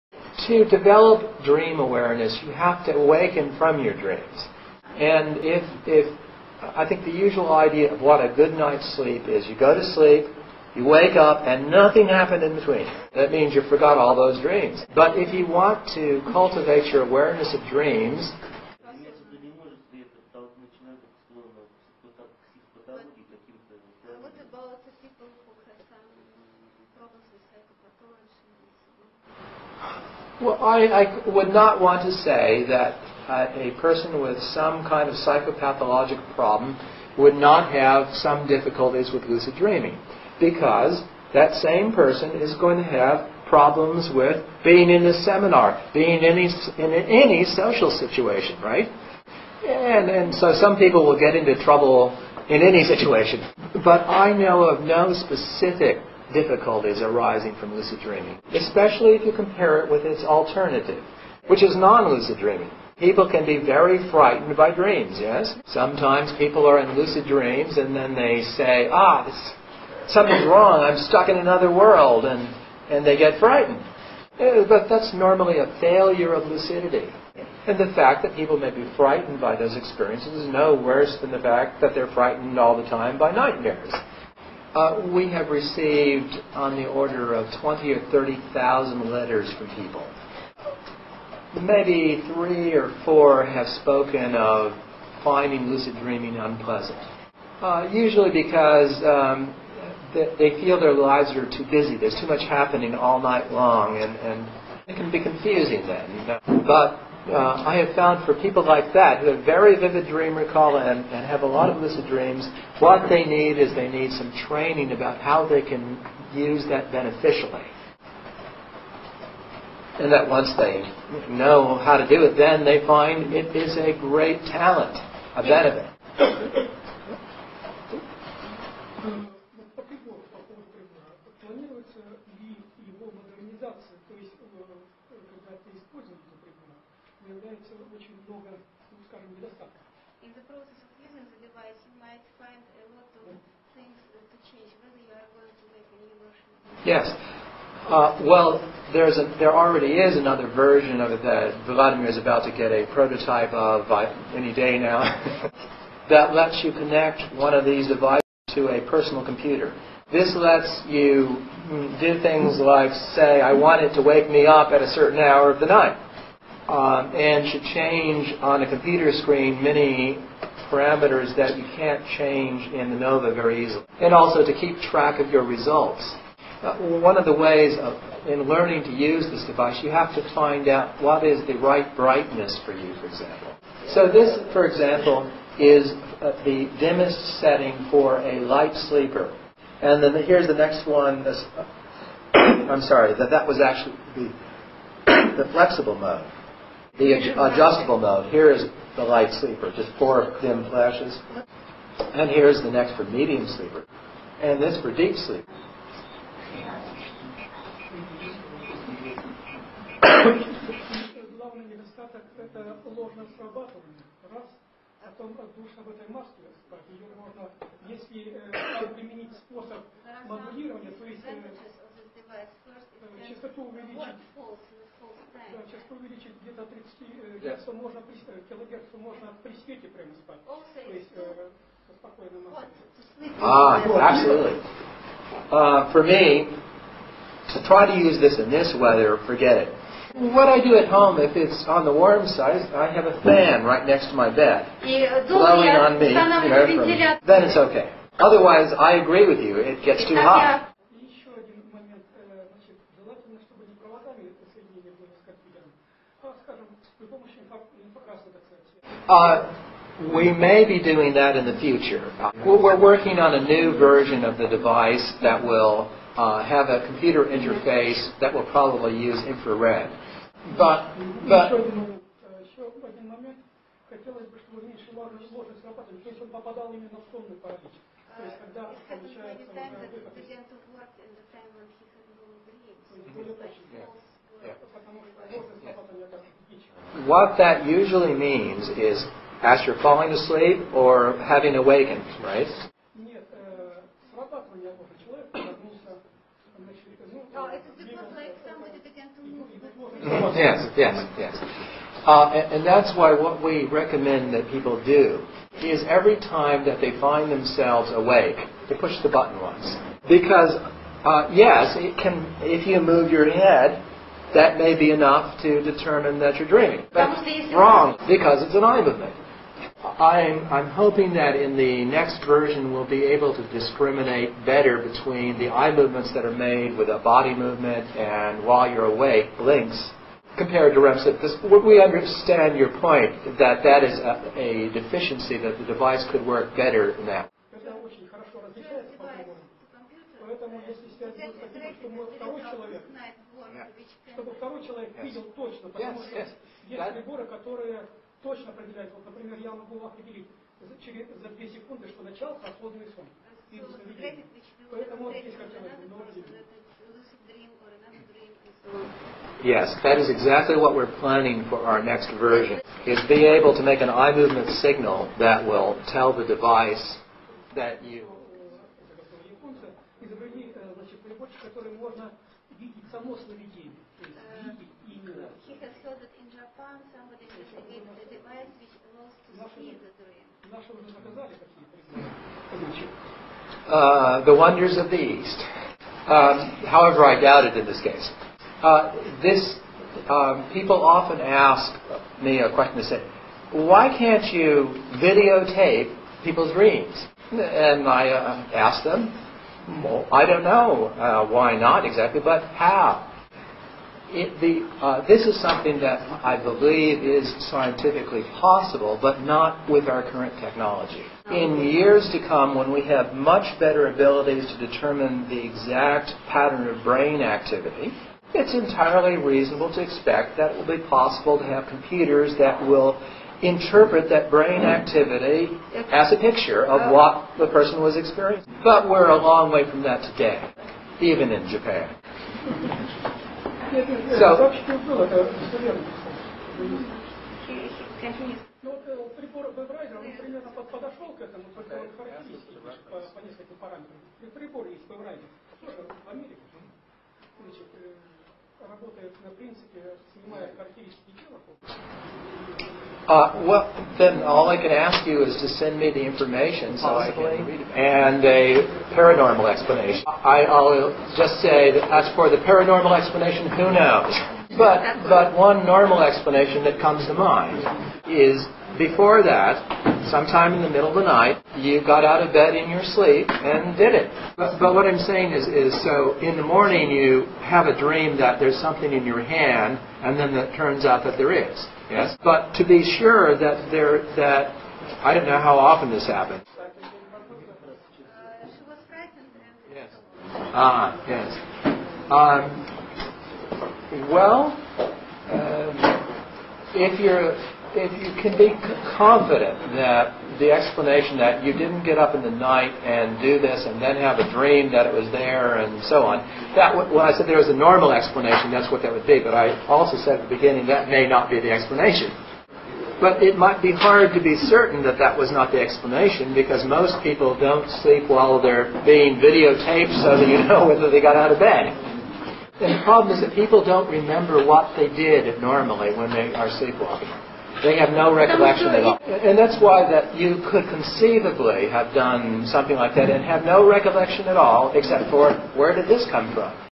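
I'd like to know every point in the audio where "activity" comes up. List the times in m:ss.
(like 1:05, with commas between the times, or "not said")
6:57, 7:04.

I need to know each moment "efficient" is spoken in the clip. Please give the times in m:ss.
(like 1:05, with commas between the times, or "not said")
not said.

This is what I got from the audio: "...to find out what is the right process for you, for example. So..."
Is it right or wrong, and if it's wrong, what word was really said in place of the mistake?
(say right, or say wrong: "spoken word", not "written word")
wrong: "brightness", not "process".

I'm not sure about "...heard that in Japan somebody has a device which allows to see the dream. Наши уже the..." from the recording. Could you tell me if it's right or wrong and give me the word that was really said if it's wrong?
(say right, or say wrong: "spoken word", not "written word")
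right.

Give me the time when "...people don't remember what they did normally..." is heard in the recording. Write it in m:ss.
8:43.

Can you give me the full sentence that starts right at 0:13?
That means you forgot all those dreams.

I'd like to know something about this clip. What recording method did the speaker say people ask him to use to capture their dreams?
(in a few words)
Videotape.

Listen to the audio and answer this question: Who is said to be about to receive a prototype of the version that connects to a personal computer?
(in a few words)
Vladimir.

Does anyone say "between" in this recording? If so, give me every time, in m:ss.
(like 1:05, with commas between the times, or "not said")
0:12, 5:24.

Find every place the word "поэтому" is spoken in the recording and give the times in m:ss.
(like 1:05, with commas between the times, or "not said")
5:40, 5:54.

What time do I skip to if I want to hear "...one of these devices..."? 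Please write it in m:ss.
2:37.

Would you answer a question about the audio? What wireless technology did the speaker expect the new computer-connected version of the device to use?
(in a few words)
Infrared.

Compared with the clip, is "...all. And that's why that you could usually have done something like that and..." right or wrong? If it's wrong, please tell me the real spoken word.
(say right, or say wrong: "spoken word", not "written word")
wrong: "conceivably", not "usually".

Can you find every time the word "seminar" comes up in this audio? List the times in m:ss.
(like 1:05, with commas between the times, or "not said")
0:45.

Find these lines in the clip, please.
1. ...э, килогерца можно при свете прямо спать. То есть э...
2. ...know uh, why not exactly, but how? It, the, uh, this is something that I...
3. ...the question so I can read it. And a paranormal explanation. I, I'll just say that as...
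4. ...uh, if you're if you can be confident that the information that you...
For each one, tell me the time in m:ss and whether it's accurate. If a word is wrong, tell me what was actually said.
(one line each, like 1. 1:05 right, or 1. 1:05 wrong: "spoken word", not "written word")
1. 3:48 right
2. 6:40 right
3. 7:35 wrong: "information", not "question"
4. 8:15 wrong: "explanation", not "information".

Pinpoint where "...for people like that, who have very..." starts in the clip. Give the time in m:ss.
1:48.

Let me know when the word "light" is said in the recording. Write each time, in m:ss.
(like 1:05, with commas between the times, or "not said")
3:08, 3:19.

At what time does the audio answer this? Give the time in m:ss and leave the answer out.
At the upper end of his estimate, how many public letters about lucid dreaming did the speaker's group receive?
1:28.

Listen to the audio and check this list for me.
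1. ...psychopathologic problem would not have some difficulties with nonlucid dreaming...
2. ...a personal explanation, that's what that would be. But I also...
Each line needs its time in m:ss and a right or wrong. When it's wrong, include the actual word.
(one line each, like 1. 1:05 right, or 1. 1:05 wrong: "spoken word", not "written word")
1. 0:35 wrong: "lucid", not "nonlucid"
2. 8:27 wrong: "normal", not "personal".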